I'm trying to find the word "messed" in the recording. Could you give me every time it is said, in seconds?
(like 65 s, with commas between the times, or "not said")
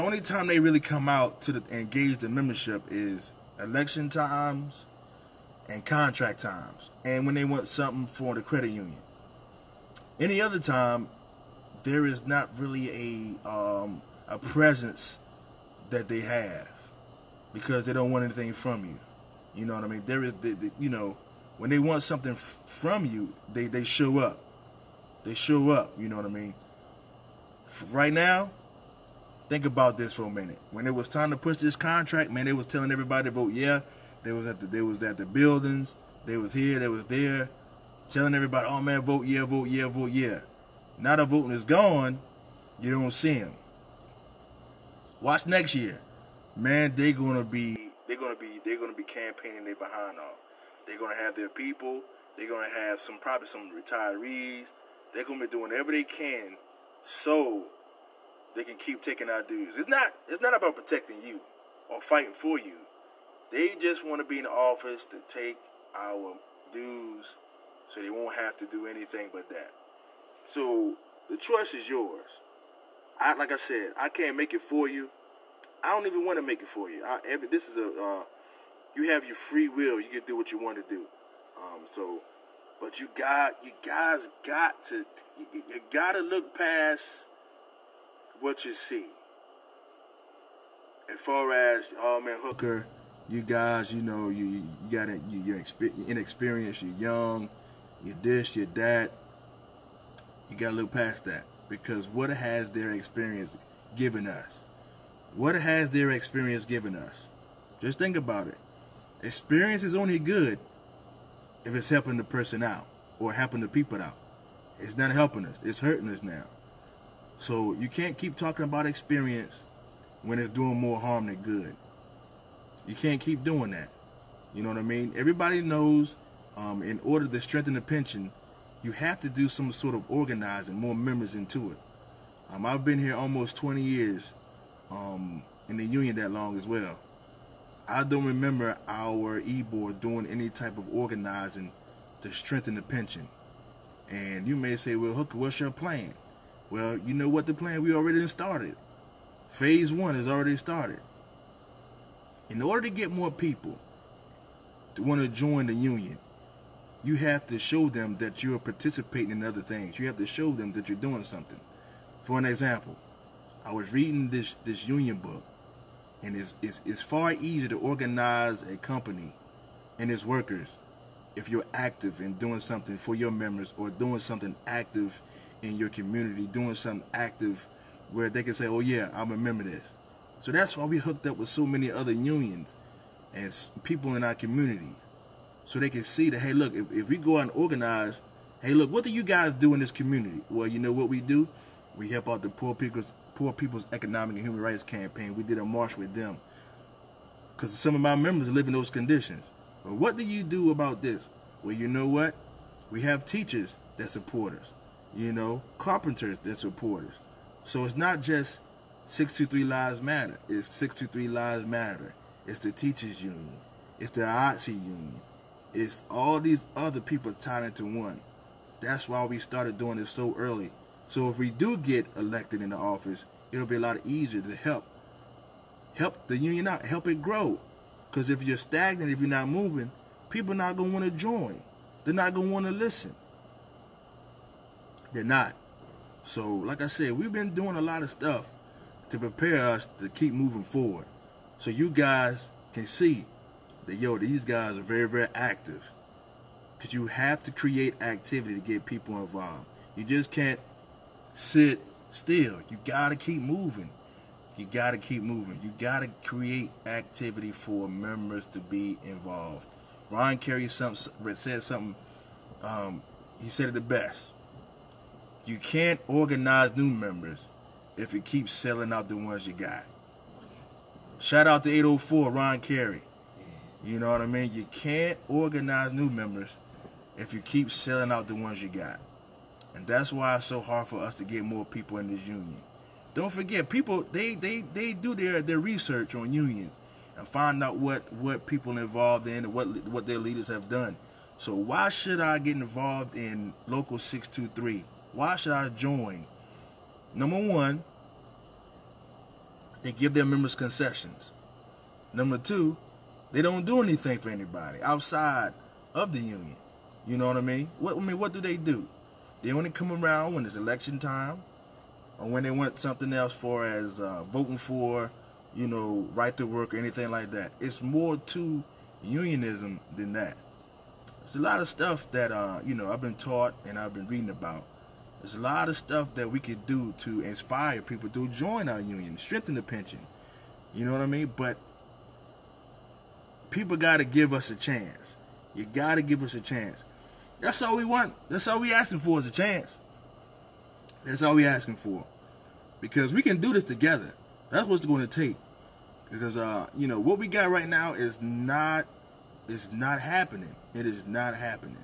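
not said.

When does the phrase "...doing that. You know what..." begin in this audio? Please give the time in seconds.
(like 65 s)
123 s.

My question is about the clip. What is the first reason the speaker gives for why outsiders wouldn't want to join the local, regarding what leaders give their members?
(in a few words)
concessions.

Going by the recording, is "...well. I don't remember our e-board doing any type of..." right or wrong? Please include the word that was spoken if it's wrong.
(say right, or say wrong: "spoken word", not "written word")
right.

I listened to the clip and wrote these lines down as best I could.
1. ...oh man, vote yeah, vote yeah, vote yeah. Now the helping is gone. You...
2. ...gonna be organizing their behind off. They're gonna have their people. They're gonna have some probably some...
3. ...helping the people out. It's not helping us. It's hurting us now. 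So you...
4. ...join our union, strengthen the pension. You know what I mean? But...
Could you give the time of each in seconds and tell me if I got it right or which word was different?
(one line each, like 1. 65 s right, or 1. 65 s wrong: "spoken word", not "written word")
1. 38 s wrong: "voting", not "helping"
2. 48 s wrong: "campaigning", not "organizing"
3. 113 s right
4. 328 s right.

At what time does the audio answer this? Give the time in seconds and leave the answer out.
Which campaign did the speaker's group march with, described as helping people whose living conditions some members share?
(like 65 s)
193 s.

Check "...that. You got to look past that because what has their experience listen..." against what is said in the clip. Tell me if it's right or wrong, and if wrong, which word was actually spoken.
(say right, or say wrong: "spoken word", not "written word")
wrong: "given", not "listen".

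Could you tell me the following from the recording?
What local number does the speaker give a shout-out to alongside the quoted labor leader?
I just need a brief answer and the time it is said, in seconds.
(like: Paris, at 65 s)
804, at 271 s.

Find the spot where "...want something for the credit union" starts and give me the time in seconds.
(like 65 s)
7 s.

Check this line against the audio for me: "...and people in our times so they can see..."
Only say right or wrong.
wrong.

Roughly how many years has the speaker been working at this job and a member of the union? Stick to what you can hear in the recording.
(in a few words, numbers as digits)
almost 20 years.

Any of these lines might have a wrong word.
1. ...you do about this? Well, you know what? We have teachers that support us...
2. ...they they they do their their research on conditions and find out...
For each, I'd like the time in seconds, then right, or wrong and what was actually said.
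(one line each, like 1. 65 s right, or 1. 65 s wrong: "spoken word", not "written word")
1. 200 s right
2. 284 s wrong: "unions", not "conditions".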